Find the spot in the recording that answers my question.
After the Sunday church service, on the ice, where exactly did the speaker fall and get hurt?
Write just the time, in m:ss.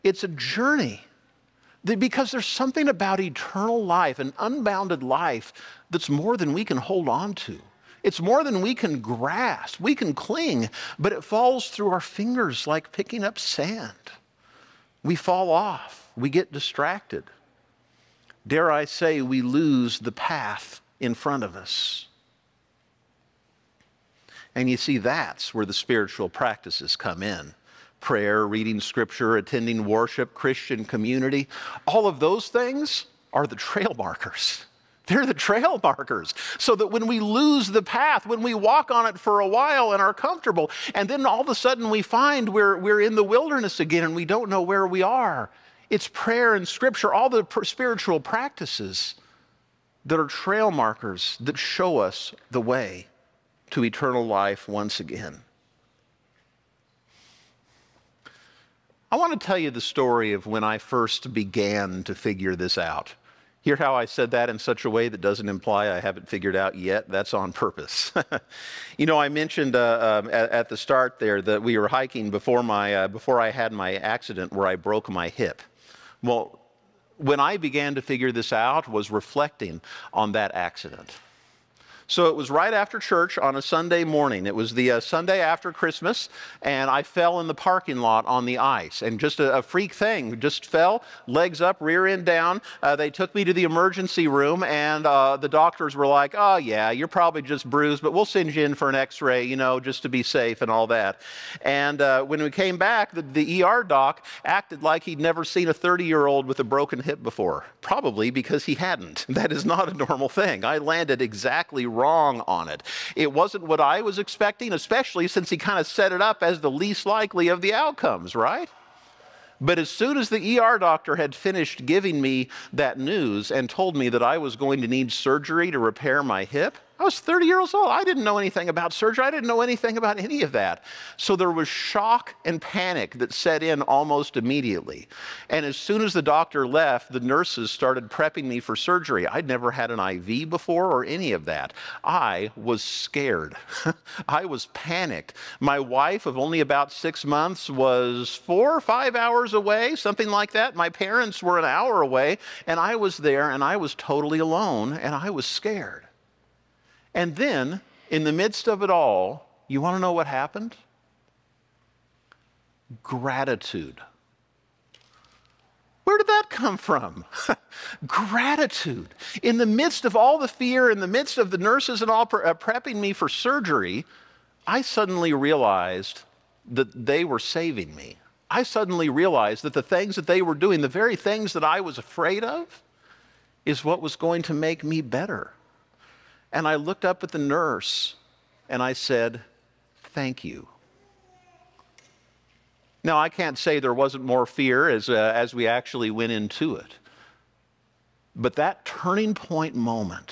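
1:27.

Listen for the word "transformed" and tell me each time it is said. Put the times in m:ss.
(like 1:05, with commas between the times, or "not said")
not said.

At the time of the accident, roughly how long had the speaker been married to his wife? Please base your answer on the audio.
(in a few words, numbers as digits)
about 6 months.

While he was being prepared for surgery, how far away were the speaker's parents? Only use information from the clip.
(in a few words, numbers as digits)
an hour away.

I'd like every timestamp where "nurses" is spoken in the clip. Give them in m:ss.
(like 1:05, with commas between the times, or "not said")
2:17, 2:51, 3:07.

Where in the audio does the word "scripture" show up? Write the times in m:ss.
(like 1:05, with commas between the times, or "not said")
0:28, 0:46.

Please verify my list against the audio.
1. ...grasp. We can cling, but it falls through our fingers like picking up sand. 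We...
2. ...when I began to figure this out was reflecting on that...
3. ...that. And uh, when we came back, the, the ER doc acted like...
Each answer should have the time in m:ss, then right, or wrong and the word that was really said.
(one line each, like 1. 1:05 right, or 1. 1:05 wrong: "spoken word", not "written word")
1. 0:08 right
2. 1:17 right
3. 1:40 right.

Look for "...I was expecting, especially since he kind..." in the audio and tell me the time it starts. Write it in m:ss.
1:53.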